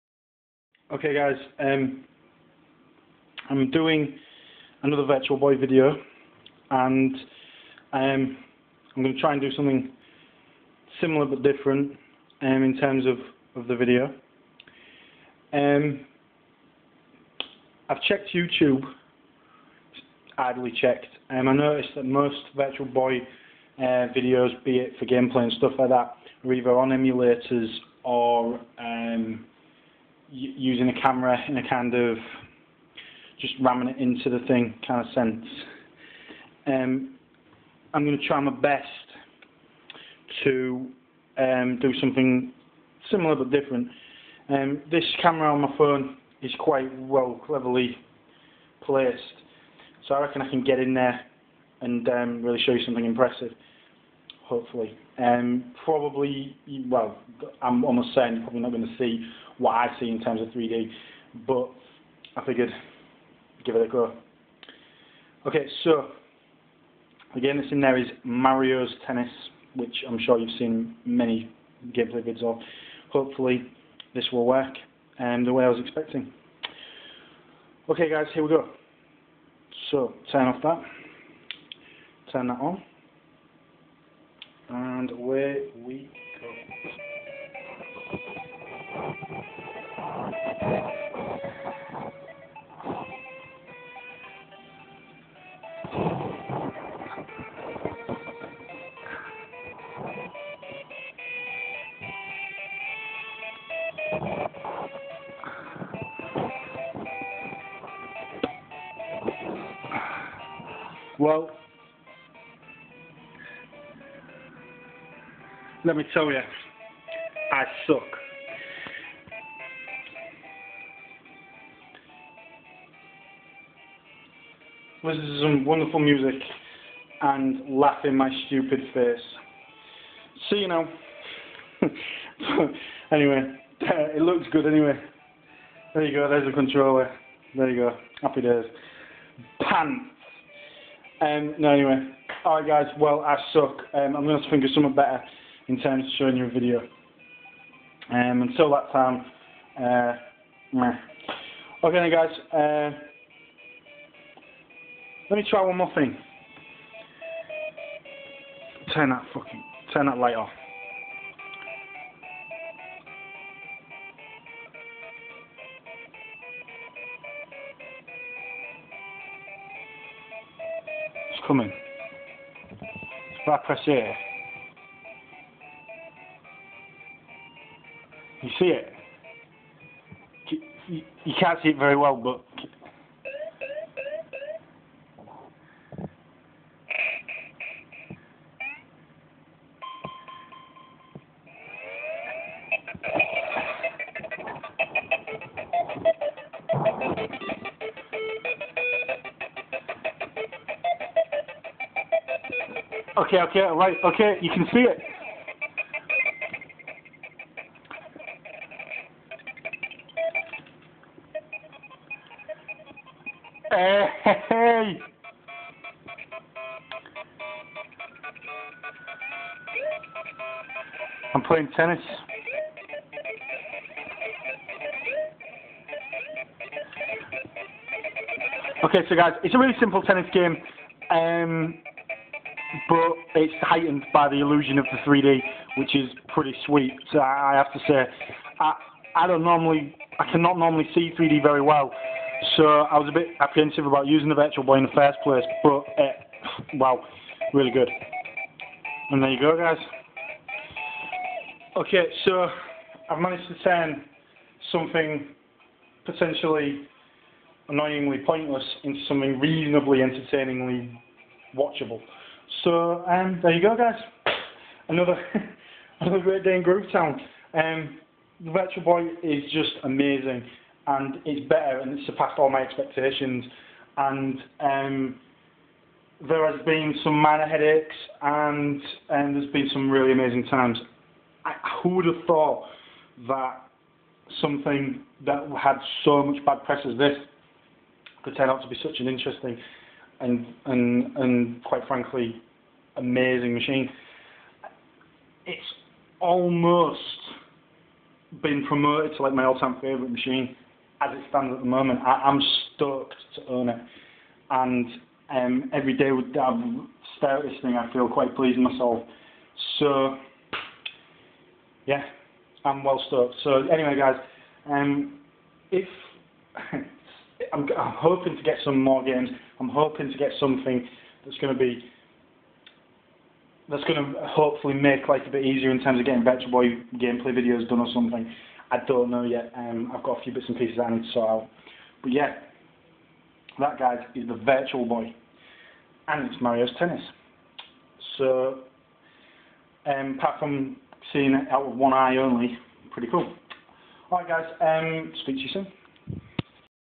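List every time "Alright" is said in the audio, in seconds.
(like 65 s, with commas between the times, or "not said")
142 s, 344 s.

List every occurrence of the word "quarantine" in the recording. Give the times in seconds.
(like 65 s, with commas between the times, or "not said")
not said.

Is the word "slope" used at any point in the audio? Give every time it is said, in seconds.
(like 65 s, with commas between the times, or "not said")
not said.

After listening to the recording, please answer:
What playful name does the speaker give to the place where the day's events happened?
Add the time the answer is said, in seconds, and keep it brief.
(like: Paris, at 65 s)
Groove Town, at 266 s.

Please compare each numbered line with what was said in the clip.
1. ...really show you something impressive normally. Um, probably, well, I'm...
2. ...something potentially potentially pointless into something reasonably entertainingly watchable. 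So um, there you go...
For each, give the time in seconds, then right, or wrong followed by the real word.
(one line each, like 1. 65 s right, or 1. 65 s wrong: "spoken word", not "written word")
1. 52 s wrong: "hopefully", not "normally"
2. 254 s wrong: "annoyingly", not "potentially".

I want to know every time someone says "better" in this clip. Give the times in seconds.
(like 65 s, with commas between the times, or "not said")
144 s, 271 s, 326 s.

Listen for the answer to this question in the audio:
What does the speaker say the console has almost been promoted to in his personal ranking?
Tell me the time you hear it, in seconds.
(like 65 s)
299 s.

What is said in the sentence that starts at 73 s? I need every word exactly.
Hopefully, this will work and um, the way I was expecting.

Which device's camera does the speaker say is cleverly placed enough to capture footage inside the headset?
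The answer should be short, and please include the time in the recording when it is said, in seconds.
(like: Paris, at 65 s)
phone, at 45 s.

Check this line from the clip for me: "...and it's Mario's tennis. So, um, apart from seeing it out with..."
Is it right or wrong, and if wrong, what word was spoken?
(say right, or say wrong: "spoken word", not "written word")
right.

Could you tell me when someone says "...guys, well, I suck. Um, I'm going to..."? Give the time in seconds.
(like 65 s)
142 s.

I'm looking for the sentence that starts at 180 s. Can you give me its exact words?
You can't see it very well, but...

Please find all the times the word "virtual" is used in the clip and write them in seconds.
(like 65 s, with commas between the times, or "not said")
5 s, 22 s, 244 s, 268 s, 334 s.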